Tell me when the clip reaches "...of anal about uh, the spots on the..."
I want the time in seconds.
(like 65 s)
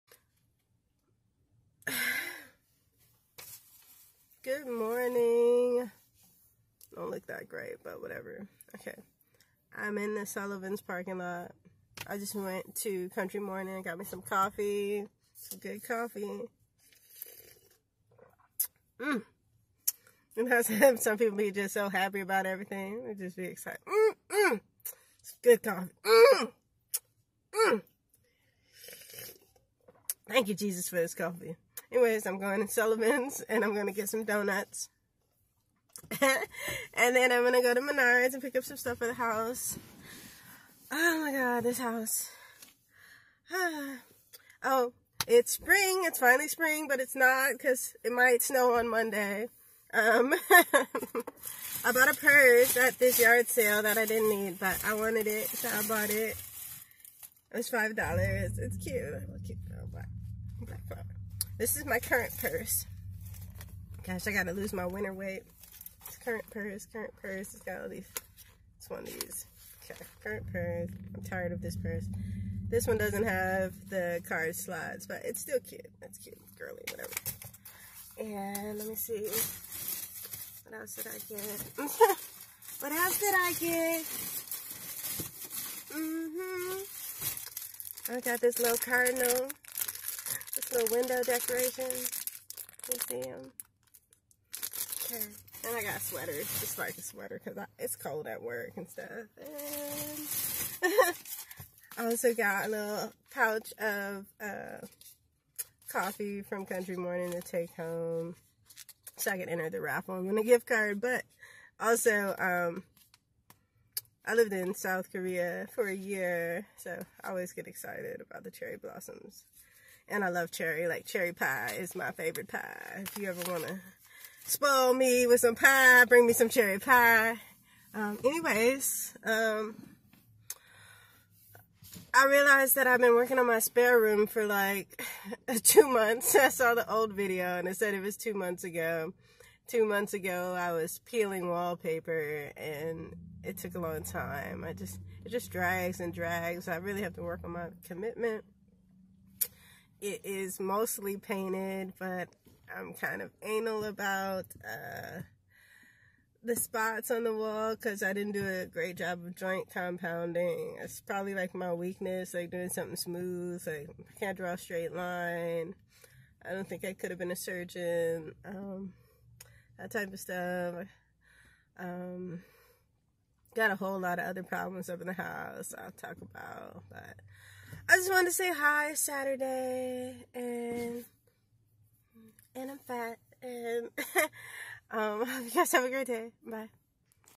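153 s.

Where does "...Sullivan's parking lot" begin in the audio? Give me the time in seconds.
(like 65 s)
10 s.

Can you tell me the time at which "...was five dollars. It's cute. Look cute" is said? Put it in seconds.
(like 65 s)
57 s.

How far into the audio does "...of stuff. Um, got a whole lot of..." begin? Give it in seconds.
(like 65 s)
170 s.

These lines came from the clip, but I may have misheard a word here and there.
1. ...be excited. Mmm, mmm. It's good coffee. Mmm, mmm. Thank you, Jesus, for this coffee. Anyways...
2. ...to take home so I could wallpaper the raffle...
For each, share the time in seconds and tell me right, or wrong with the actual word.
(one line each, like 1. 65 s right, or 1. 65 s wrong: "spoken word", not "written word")
1. 23 s right
2. 107 s wrong: "enter", not "wallpaper".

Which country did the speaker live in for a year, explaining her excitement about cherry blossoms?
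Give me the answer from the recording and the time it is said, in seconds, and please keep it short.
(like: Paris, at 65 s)
South Korea, at 114 s.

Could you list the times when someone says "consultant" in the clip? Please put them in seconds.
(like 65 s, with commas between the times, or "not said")
not said.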